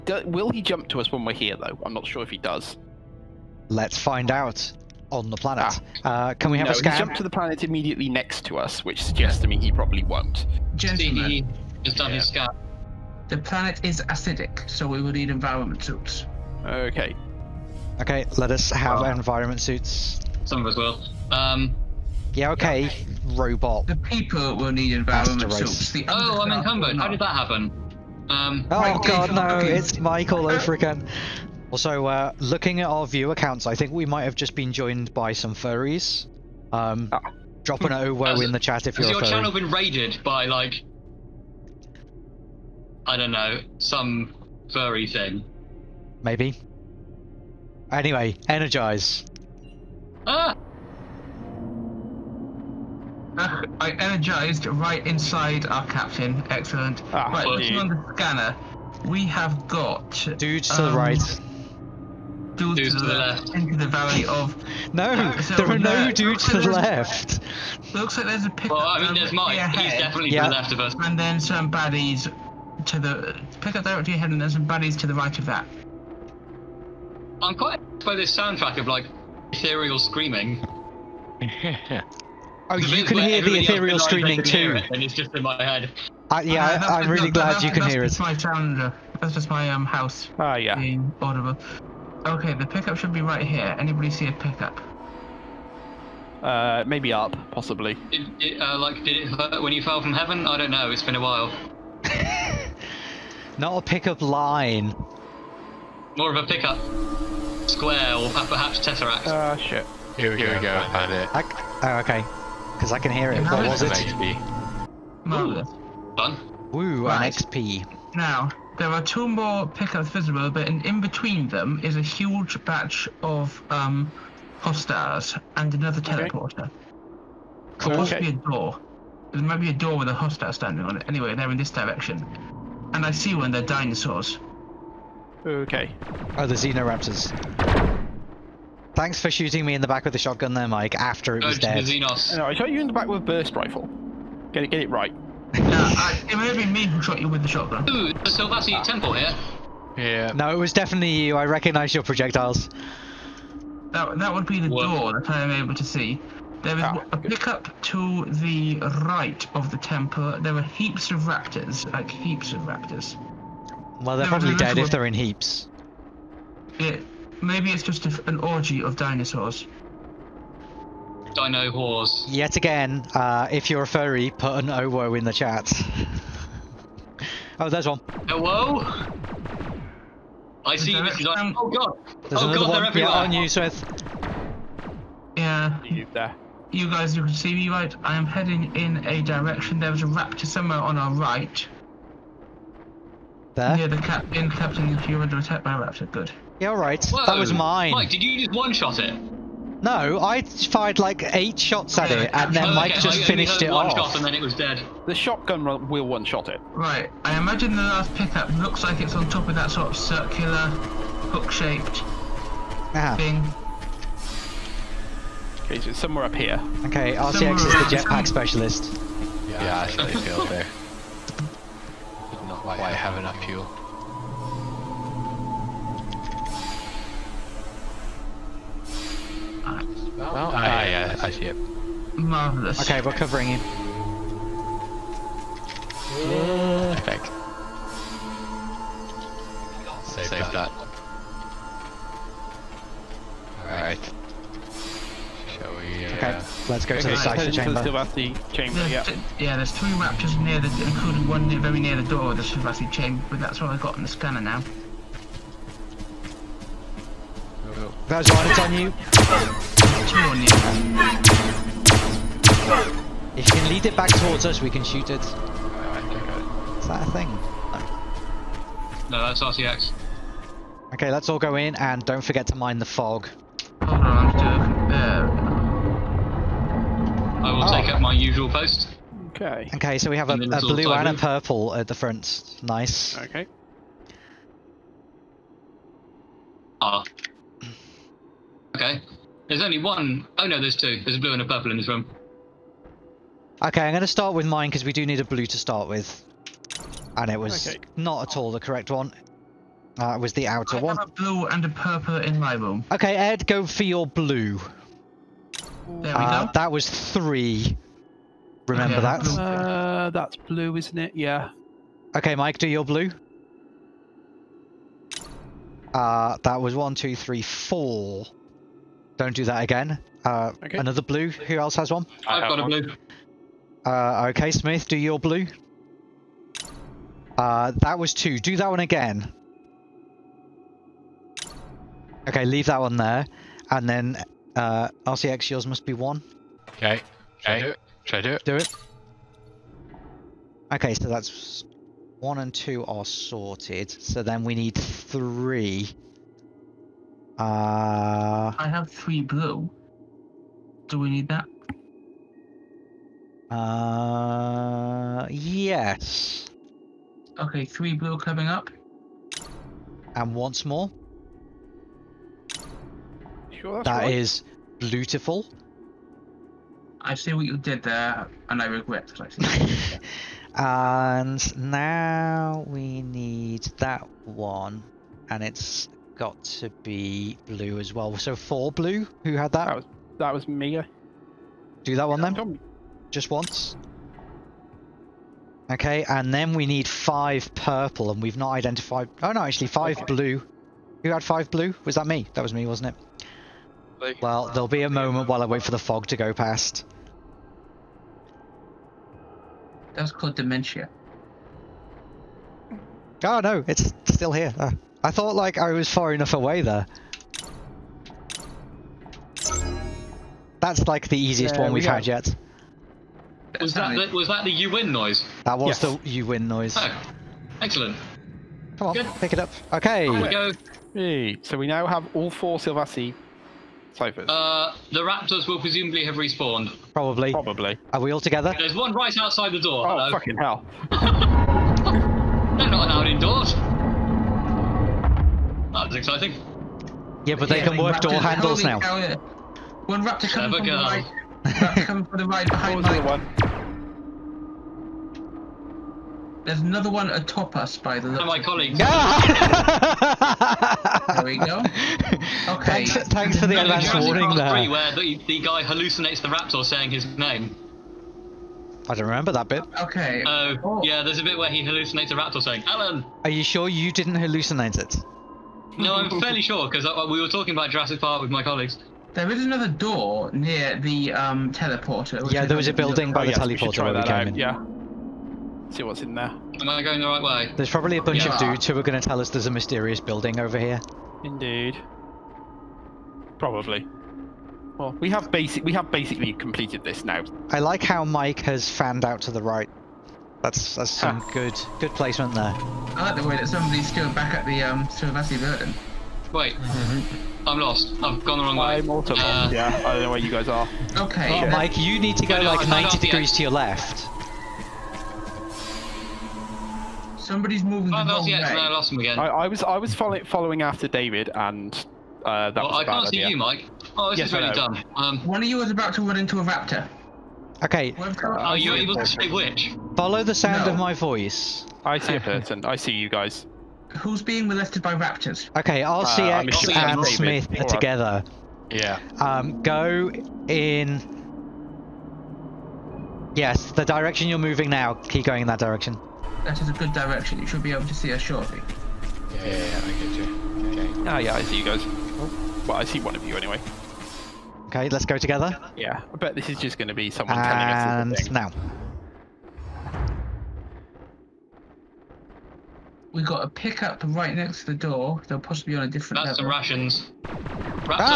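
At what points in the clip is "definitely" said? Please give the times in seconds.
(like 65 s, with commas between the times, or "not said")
69 s, 150 s.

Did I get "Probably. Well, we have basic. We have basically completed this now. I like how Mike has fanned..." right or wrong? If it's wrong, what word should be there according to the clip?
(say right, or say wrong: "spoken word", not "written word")
right.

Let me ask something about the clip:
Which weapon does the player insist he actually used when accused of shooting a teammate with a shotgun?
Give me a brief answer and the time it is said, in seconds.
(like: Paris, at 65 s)
Burst rifle, at 143 s.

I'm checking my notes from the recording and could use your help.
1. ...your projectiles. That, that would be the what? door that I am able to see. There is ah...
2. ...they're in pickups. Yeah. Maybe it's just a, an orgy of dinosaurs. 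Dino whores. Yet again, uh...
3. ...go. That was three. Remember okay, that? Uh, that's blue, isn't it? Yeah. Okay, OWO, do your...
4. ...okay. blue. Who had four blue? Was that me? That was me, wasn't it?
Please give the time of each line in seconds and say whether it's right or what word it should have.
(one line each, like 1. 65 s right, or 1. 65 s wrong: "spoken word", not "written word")
1. 151 s right
2. 164 s wrong: "heaps", not "pickups"
3. 306 s wrong: "Mike", not "OWO"
4. 389 s wrong: "five", not "four".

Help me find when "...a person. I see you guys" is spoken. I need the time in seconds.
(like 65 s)
522 s.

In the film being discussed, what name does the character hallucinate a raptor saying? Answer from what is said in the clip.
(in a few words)
Alan.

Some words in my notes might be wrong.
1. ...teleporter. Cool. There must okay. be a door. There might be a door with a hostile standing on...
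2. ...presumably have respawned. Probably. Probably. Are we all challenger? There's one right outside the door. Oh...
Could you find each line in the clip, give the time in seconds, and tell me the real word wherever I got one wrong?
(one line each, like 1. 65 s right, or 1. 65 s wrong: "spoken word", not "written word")
1. 126 s right
2. 425 s wrong: "together", not "challenger".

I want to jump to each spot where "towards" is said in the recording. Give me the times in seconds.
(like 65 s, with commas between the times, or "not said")
264 s.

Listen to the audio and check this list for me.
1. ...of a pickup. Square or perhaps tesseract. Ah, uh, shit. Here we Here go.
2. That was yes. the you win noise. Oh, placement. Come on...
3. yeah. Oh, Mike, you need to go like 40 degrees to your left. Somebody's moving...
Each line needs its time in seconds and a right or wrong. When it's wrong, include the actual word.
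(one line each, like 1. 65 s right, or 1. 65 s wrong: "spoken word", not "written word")
1. 106 s right
2. 415 s wrong: "excellent", not "placement"
3. 501 s wrong: "90", not "40".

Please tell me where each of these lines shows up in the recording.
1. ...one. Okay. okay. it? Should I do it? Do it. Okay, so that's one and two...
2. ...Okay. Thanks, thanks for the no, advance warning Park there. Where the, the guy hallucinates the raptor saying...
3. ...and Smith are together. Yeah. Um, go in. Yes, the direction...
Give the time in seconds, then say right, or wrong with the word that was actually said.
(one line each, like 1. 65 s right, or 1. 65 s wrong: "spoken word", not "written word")
1. 335 s right
2. 452 s right
3. 526 s right.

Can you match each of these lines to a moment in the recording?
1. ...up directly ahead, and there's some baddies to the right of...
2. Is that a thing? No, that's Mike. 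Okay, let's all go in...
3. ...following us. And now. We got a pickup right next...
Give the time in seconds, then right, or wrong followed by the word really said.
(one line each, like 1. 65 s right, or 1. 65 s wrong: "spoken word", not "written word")
1. 73 s right
2. 265 s wrong: "RCX", not "Mike"
3. 547 s wrong: "telling", not "following".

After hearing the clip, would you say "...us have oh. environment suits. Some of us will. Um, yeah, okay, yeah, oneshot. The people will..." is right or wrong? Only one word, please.
wrong.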